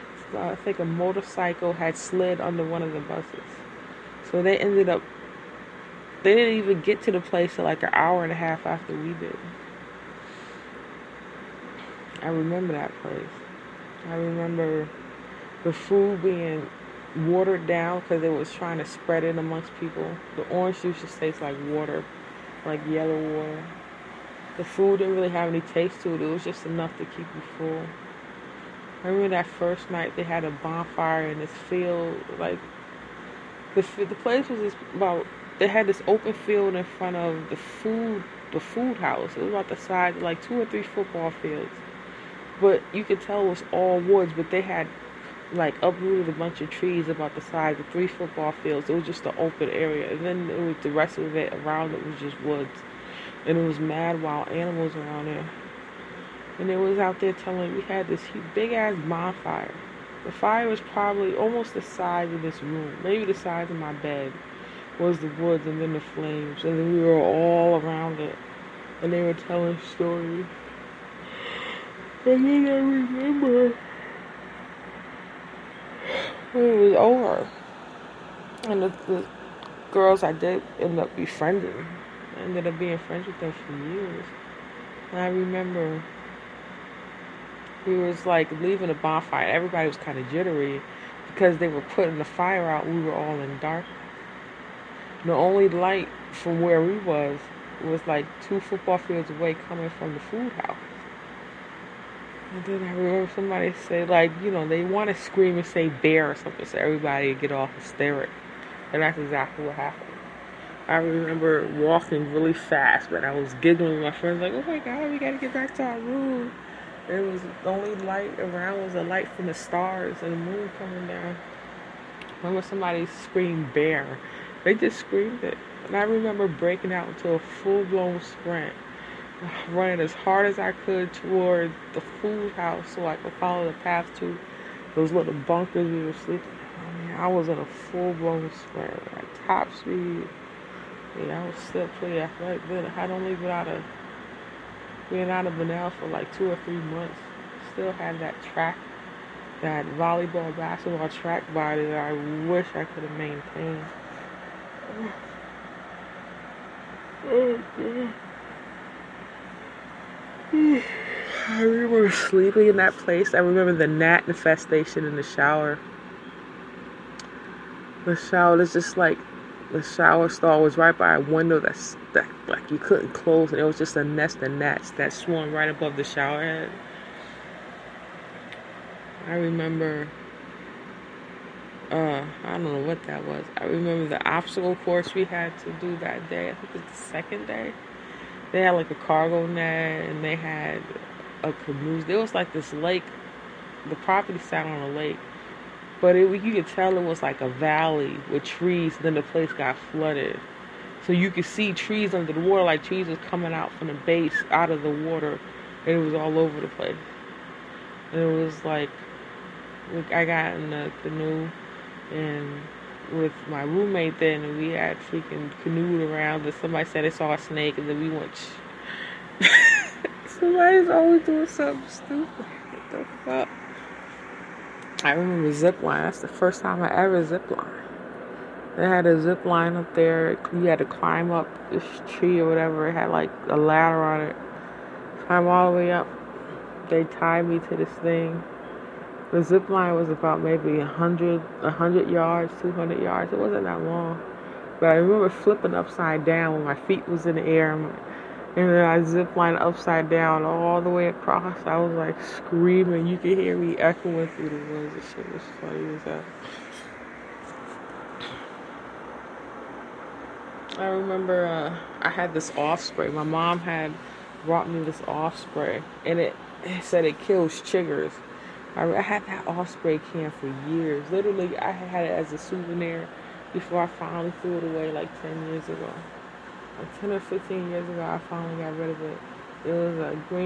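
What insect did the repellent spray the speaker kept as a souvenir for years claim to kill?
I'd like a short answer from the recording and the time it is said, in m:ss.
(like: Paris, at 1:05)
chiggers, at 4:27.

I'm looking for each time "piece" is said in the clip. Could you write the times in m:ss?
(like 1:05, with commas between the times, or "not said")
not said.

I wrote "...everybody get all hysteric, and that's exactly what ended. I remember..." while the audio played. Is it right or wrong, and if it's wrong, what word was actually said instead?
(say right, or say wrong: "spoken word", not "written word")
wrong: "happened", not "ended".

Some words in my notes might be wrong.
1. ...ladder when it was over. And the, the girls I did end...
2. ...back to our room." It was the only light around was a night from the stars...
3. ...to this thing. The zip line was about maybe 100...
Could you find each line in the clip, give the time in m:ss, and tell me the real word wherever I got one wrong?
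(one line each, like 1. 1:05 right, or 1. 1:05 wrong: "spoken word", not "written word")
1. 1:12 wrong: "remember", not "ladder"
2. 1:55 wrong: "light", not "night"
3. 3:57 right.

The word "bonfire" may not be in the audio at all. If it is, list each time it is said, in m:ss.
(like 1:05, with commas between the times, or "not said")
0:30, 0:59, 1:28.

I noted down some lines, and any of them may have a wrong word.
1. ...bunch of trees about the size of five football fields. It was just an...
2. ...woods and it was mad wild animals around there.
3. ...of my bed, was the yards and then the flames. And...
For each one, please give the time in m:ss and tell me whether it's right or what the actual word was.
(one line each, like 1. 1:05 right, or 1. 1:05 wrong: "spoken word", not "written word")
1. 0:46 wrong: "three", not "five"
2. 0:52 right
3. 1:03 wrong: "woods", not "yards".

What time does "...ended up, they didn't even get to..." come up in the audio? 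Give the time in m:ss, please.
0:04.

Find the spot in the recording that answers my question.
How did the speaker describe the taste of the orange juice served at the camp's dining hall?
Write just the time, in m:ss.
0:22.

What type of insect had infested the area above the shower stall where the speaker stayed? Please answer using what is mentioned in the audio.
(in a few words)
gnats.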